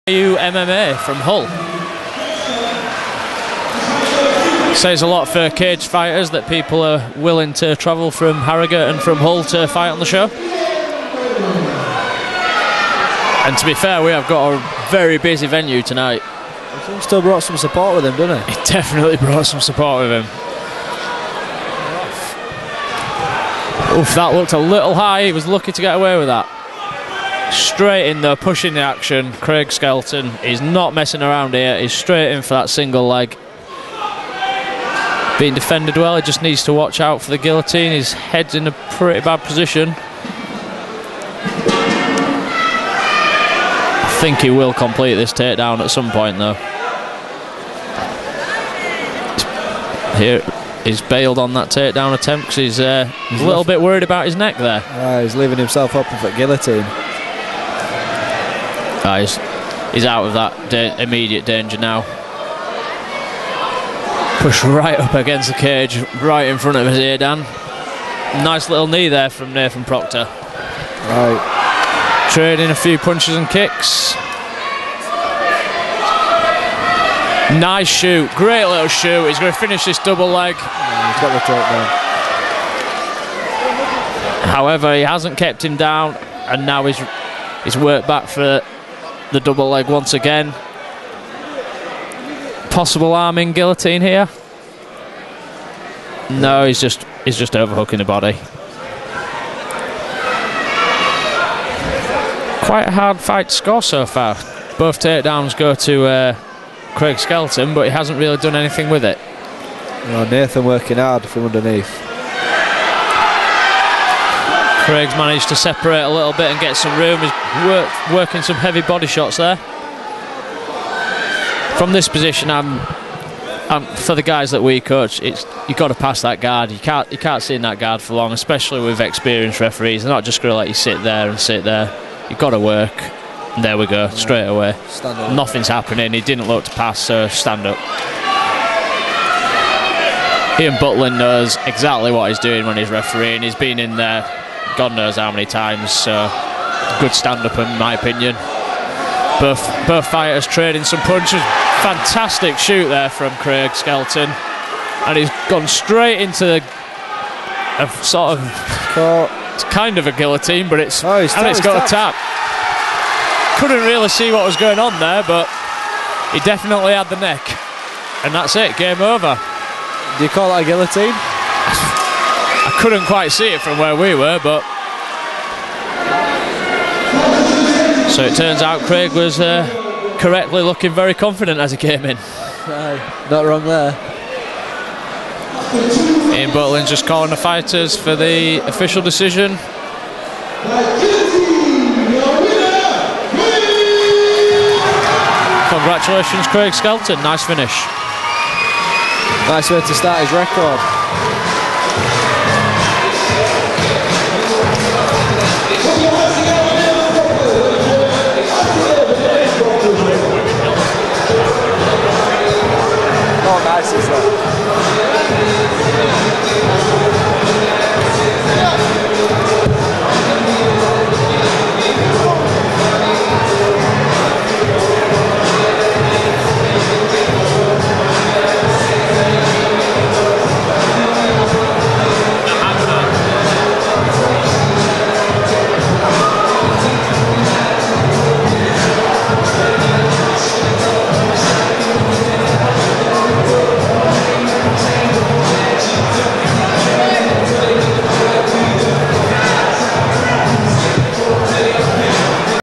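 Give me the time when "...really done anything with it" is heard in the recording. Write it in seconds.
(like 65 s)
108 s.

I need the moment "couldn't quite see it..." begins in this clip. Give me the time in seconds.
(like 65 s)
172 s.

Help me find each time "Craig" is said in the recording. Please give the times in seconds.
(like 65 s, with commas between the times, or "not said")
29 s, 106 s, 114 s, 153 s, 178 s, 196 s.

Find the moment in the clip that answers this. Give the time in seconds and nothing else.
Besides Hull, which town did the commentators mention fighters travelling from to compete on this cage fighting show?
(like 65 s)
8 s.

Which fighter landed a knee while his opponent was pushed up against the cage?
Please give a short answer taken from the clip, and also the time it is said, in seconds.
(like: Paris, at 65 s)
Nathan Procter, at 69 s.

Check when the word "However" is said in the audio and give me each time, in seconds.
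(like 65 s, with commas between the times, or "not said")
84 s.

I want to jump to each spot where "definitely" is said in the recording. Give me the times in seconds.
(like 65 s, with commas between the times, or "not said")
18 s, 166 s.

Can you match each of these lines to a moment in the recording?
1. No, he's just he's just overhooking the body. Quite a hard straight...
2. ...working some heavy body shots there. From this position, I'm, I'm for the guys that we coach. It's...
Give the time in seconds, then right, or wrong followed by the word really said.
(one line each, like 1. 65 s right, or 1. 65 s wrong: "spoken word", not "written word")
1. 96 s wrong: "fight", not "straight"
2. 118 s right.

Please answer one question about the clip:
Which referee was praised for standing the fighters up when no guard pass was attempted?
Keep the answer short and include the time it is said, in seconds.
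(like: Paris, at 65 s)
Ian Butland, at 140 s.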